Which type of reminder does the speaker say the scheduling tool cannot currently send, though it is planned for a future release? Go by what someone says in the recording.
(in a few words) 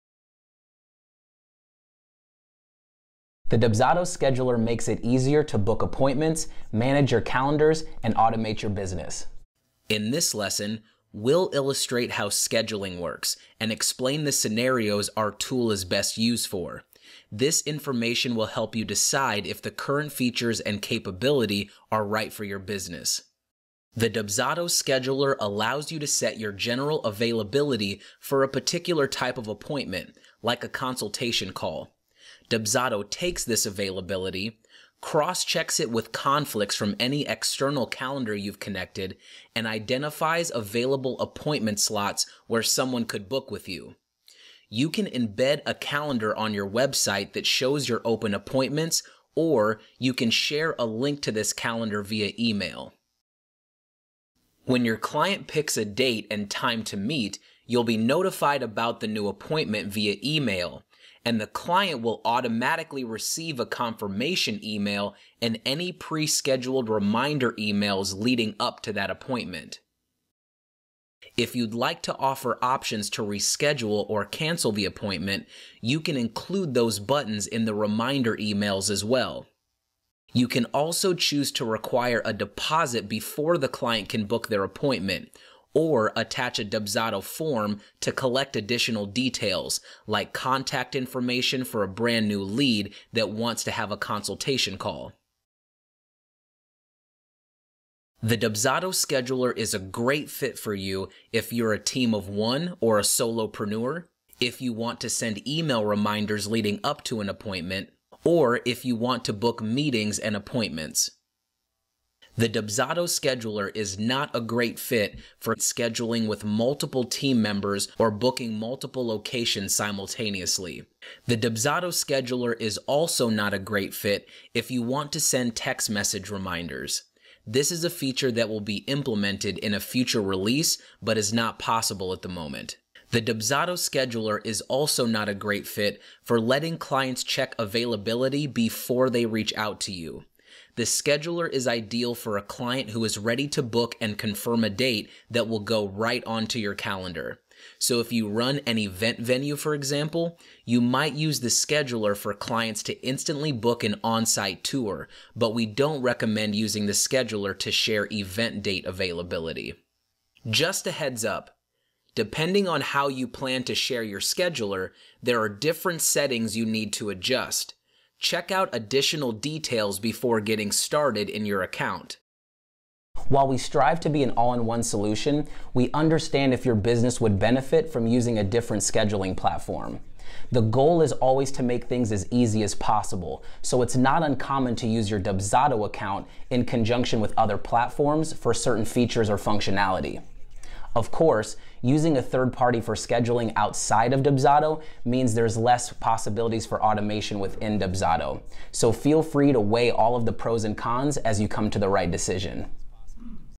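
text message reminders.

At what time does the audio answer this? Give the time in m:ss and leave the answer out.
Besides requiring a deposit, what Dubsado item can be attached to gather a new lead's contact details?
1:26.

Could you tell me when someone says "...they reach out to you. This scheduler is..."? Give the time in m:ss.
2:19.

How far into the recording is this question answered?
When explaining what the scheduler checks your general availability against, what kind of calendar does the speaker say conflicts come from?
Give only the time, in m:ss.
0:37.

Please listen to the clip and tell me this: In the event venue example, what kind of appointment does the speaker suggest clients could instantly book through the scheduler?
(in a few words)
on-site tour.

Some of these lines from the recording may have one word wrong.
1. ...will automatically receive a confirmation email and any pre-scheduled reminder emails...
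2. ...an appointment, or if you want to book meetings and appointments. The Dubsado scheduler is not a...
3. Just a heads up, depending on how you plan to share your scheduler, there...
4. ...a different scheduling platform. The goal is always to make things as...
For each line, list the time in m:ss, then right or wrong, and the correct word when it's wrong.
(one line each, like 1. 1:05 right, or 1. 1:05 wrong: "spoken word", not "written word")
1. 1:02 right
2. 1:47 right
3. 2:40 right
4. 2:58 right.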